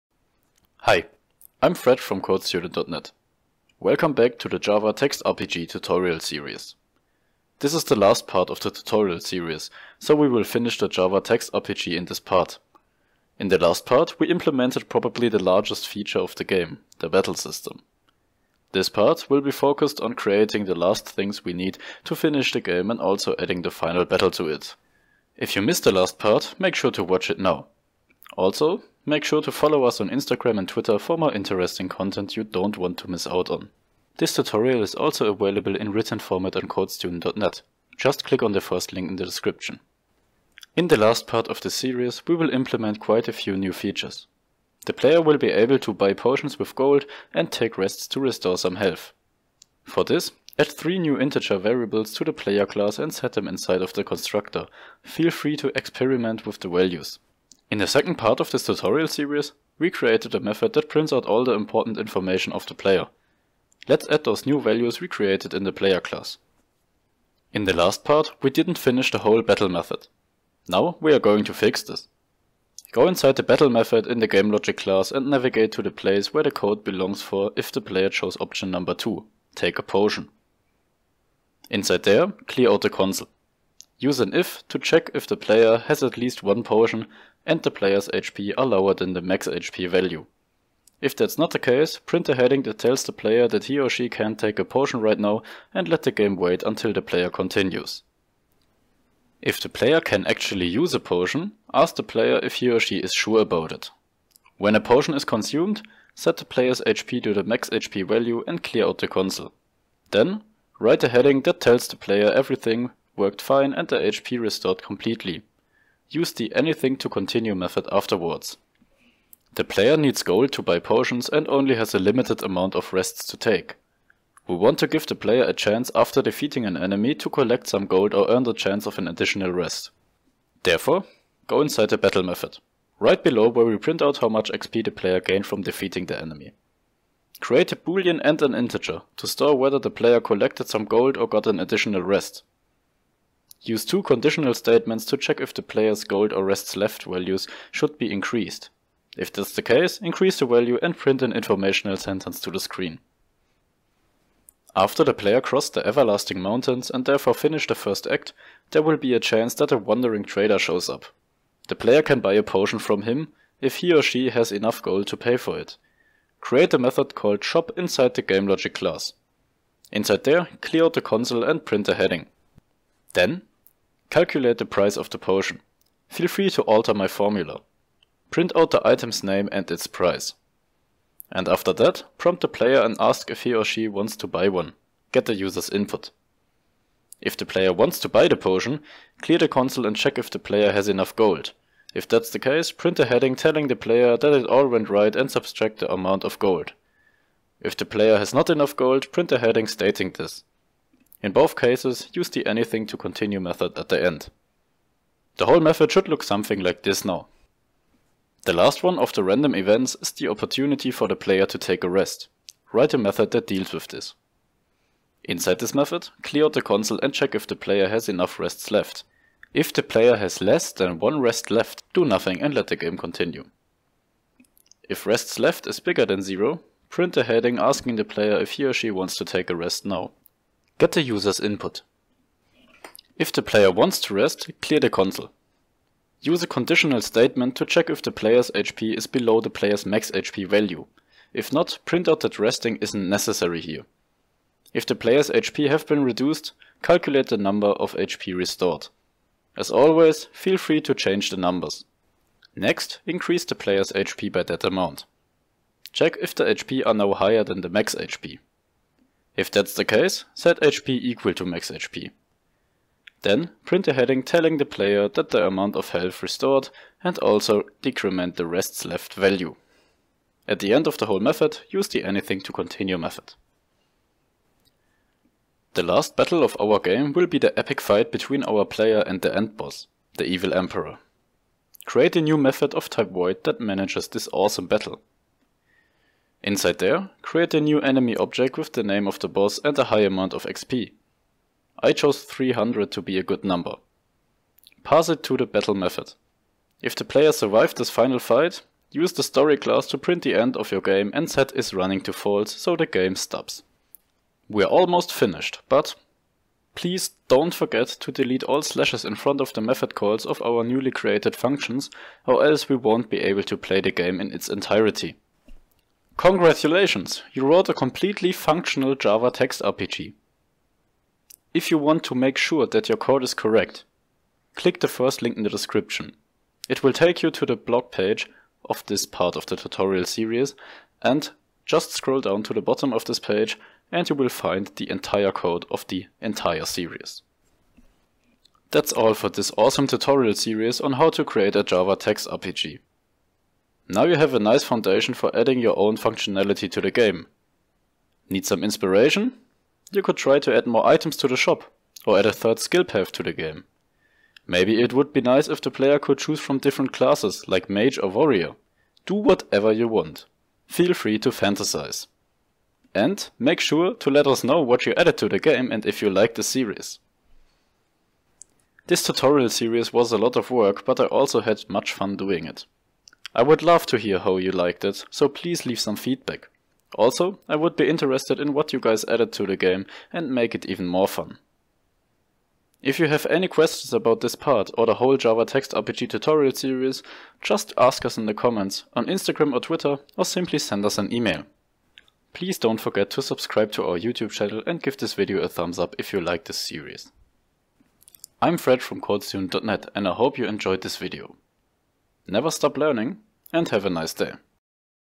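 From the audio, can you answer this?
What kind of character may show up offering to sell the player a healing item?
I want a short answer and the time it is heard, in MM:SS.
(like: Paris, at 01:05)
Wandering Trader, at 02:39.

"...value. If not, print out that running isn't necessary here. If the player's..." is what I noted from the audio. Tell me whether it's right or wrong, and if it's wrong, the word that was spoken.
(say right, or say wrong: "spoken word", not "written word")
wrong: "resting", not "running".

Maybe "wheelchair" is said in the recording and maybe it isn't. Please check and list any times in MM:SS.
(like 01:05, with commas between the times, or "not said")
not said.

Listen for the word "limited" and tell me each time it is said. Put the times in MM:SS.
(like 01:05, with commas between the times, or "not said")
02:01.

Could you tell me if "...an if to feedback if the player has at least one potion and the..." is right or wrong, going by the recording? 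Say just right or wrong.
wrong.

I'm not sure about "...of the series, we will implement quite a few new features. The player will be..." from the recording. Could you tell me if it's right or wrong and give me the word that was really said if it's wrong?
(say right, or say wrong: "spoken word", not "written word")
right.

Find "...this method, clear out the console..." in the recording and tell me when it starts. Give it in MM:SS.
03:35.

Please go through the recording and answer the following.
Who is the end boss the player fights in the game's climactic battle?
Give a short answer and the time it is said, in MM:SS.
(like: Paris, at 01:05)
the evil emperor, at 04:40.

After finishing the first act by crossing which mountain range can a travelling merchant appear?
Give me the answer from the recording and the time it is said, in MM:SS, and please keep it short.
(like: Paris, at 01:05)
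Everlasting Mountains, at 02:35.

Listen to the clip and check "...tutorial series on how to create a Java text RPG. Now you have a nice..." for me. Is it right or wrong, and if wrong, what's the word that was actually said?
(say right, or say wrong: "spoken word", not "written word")
right.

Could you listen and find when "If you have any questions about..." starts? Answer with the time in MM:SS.
06:22.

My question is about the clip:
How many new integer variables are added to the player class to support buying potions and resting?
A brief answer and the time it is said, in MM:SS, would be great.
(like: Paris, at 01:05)
3, at 00:50.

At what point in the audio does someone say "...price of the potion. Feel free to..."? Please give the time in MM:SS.
02:54.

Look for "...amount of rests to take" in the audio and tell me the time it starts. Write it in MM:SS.
02:02.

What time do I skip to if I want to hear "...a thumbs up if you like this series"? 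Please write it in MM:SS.
06:35.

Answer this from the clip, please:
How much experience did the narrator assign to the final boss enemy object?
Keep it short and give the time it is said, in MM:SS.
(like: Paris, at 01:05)
300, at 04:52.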